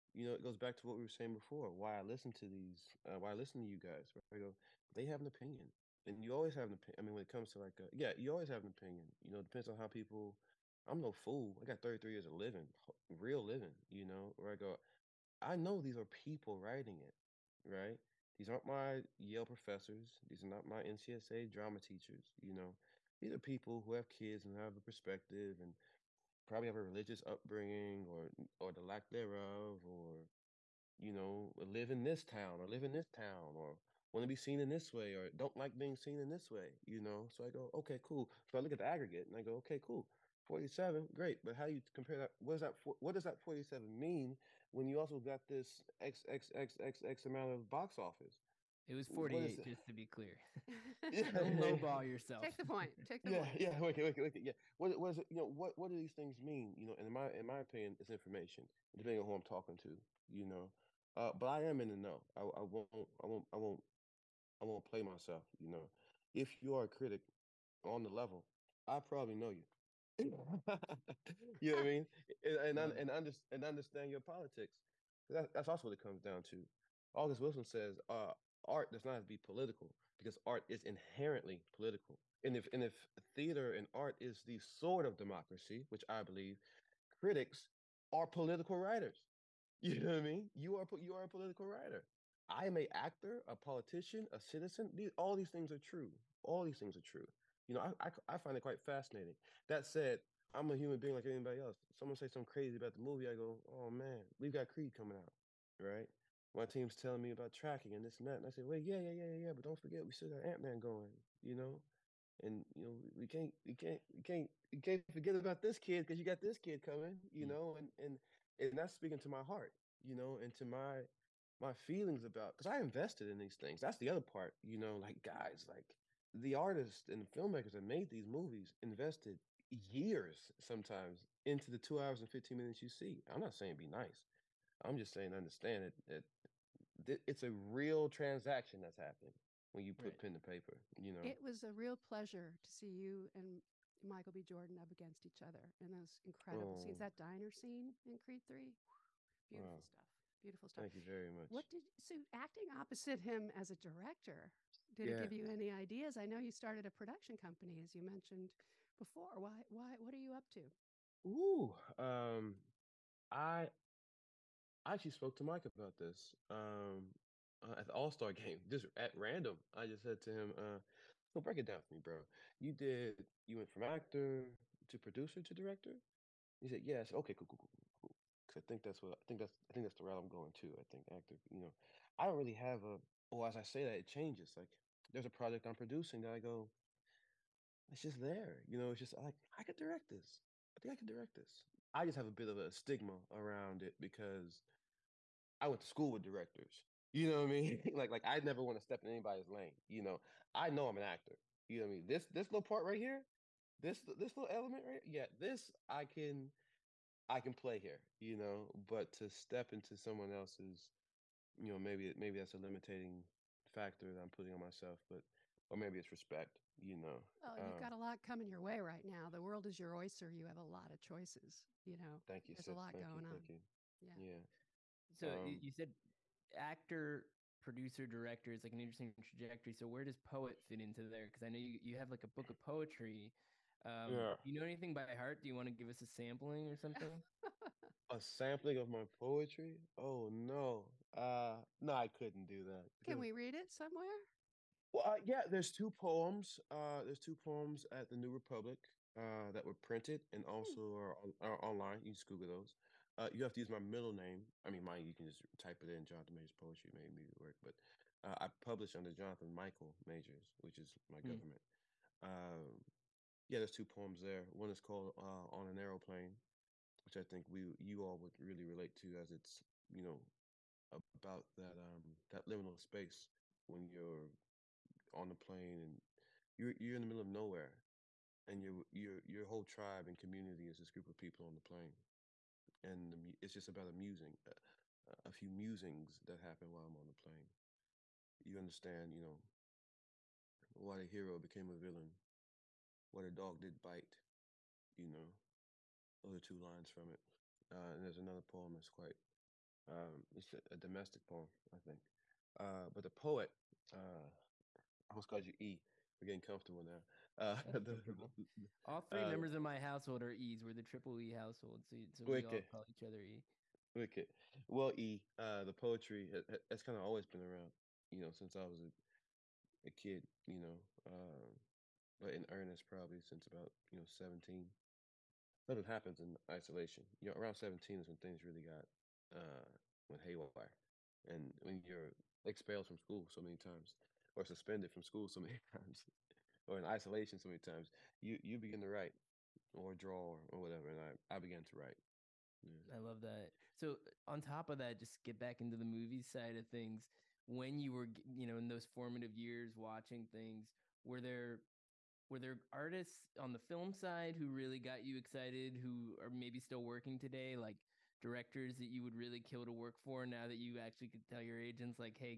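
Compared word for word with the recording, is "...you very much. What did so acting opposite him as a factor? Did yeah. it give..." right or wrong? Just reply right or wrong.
wrong.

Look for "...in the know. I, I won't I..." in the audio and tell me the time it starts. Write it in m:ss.
1:01.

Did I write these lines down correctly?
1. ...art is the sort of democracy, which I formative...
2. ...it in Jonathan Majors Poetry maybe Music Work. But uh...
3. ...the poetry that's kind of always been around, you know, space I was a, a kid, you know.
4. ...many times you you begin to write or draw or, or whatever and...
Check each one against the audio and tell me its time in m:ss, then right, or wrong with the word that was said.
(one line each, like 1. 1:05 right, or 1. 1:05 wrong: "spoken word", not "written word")
1. 1:23 wrong: "believe", not "formative"
2. 4:15 right
3. 5:15 wrong: "since", not "space"
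4. 5:37 right.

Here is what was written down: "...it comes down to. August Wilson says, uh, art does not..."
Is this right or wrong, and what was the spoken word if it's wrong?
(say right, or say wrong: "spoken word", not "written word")
right.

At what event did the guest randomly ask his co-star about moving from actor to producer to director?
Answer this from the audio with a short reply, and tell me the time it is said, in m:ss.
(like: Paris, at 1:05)
All Star game, at 2:47.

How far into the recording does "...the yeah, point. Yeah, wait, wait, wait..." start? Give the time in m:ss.
0:53.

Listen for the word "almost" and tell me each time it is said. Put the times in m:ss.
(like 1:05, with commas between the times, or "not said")
5:05.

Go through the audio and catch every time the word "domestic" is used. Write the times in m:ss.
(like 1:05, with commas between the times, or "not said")
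5:00.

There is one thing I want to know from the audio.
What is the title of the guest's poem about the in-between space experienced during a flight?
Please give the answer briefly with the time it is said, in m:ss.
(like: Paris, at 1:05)
On an Aeroplane, at 4:25.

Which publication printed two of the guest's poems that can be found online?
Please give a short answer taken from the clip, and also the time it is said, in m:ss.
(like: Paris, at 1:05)
The New Republic, at 4:08.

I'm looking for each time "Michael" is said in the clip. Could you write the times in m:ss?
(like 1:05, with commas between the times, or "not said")
2:24, 4:19.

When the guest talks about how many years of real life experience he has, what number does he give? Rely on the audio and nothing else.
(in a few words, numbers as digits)
33.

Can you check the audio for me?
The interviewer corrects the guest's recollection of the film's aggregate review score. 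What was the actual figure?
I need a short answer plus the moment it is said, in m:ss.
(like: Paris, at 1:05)
48, at 0:49.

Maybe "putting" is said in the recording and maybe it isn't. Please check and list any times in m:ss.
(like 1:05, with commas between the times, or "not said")
3:34.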